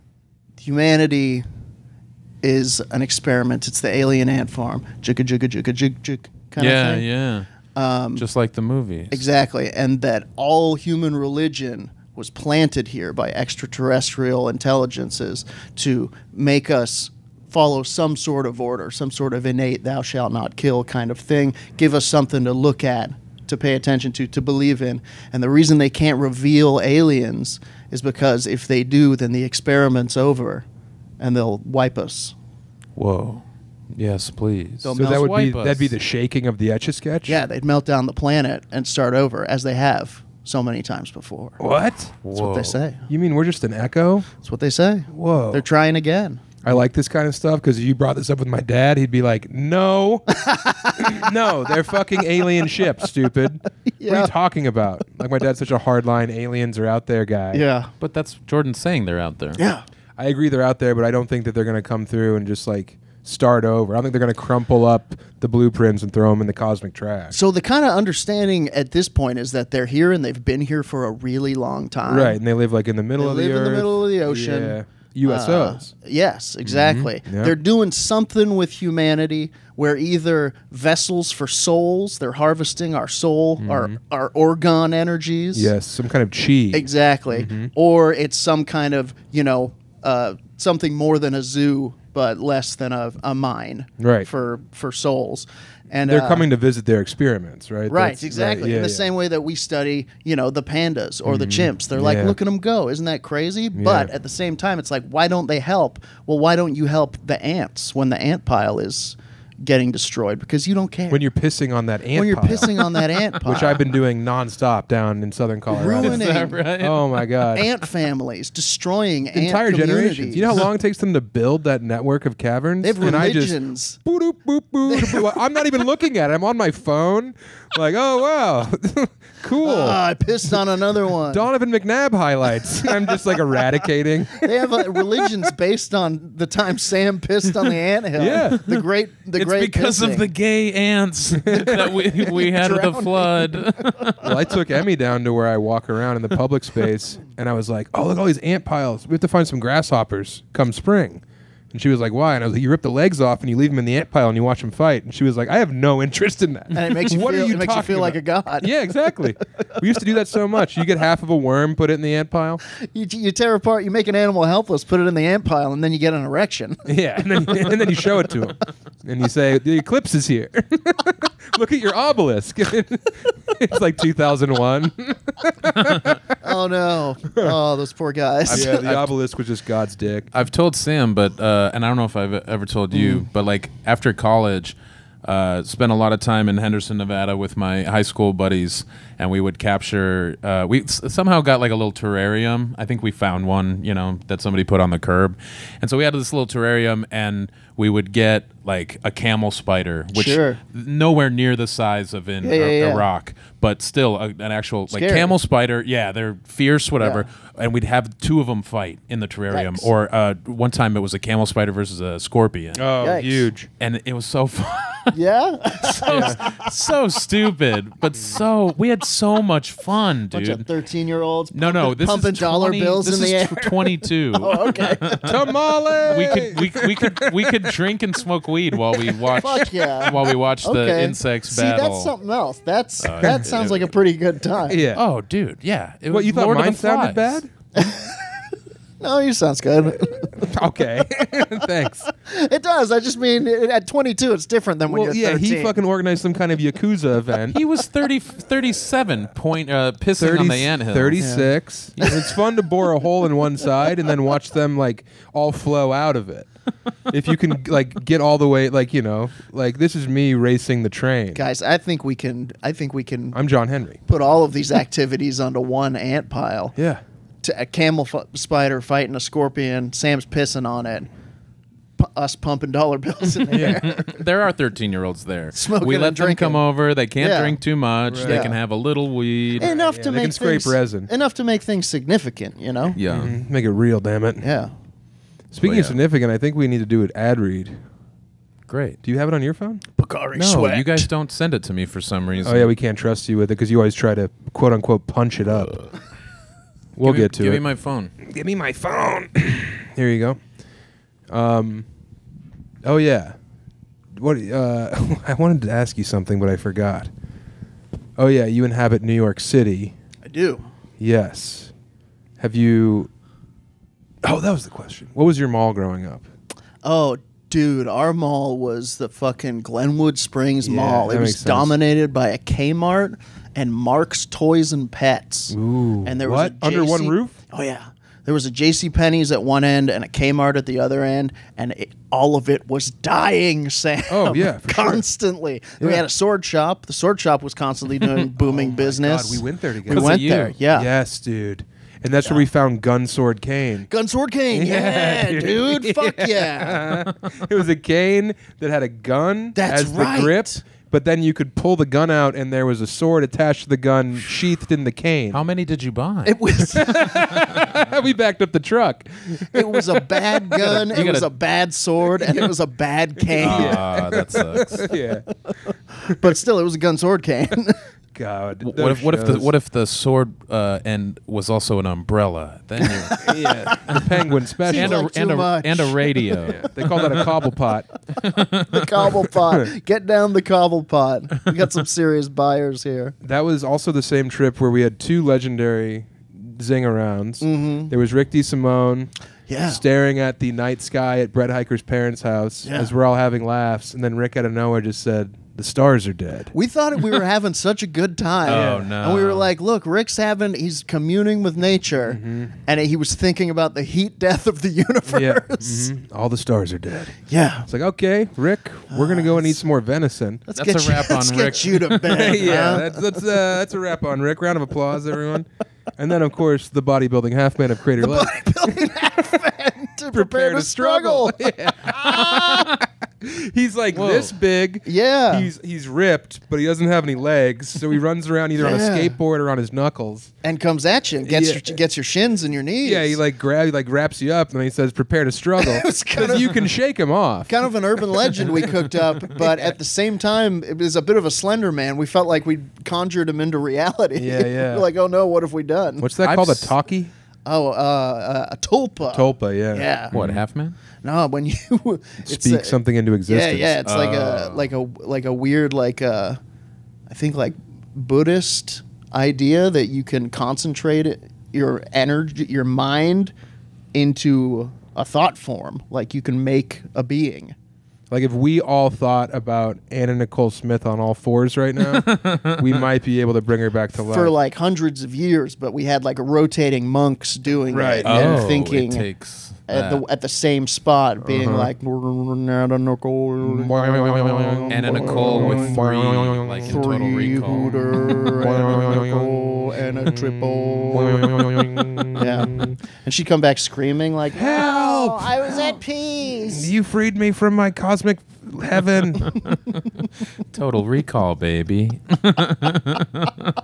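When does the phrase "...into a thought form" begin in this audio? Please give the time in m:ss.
7:43.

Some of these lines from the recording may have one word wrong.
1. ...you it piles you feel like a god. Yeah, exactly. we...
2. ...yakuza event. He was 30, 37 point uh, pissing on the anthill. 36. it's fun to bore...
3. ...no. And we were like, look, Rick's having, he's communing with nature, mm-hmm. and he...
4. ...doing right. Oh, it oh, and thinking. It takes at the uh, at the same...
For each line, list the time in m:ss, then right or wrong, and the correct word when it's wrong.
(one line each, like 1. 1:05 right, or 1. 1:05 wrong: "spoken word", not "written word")
1. 2:37 wrong: "makes", not "piles"
2. 4:06 right
3. 6:38 right
4. 7:57 right.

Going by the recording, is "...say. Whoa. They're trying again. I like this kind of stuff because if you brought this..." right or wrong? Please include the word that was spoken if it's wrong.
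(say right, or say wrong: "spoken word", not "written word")
right.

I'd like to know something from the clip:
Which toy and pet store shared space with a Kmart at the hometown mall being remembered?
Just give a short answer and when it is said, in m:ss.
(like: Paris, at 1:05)
Mark's Toys and Pets, at 5:23.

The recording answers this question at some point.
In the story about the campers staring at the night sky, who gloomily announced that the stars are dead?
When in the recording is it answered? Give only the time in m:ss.
6:28.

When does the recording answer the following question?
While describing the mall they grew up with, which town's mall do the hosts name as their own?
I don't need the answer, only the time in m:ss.
5:19.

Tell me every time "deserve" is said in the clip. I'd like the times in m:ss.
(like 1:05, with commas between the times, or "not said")
not said.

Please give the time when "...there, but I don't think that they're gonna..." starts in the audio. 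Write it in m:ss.
1:00.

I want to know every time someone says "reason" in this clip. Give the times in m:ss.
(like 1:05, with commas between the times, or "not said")
0:25, 4:52.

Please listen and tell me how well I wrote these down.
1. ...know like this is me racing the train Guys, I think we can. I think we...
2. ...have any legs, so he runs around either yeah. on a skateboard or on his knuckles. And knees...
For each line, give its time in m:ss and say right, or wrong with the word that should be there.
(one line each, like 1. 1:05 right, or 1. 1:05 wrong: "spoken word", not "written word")
1. 4:19 right
2. 7:06 wrong: "comes", not "knees".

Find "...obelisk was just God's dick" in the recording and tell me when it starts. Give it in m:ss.
2:58.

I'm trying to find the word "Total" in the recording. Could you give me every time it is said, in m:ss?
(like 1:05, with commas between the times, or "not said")
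8:06, 8:20.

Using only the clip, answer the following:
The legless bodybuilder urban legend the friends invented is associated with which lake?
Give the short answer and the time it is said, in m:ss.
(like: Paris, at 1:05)
Crater Lake, at 6:57.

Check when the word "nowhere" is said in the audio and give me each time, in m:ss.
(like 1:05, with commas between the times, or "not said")
3:20, 6:34.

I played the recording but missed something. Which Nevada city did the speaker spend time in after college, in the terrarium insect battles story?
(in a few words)
Henderson.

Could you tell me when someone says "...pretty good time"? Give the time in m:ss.
3:53.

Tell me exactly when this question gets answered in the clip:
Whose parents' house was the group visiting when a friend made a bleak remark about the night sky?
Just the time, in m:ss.
6:31.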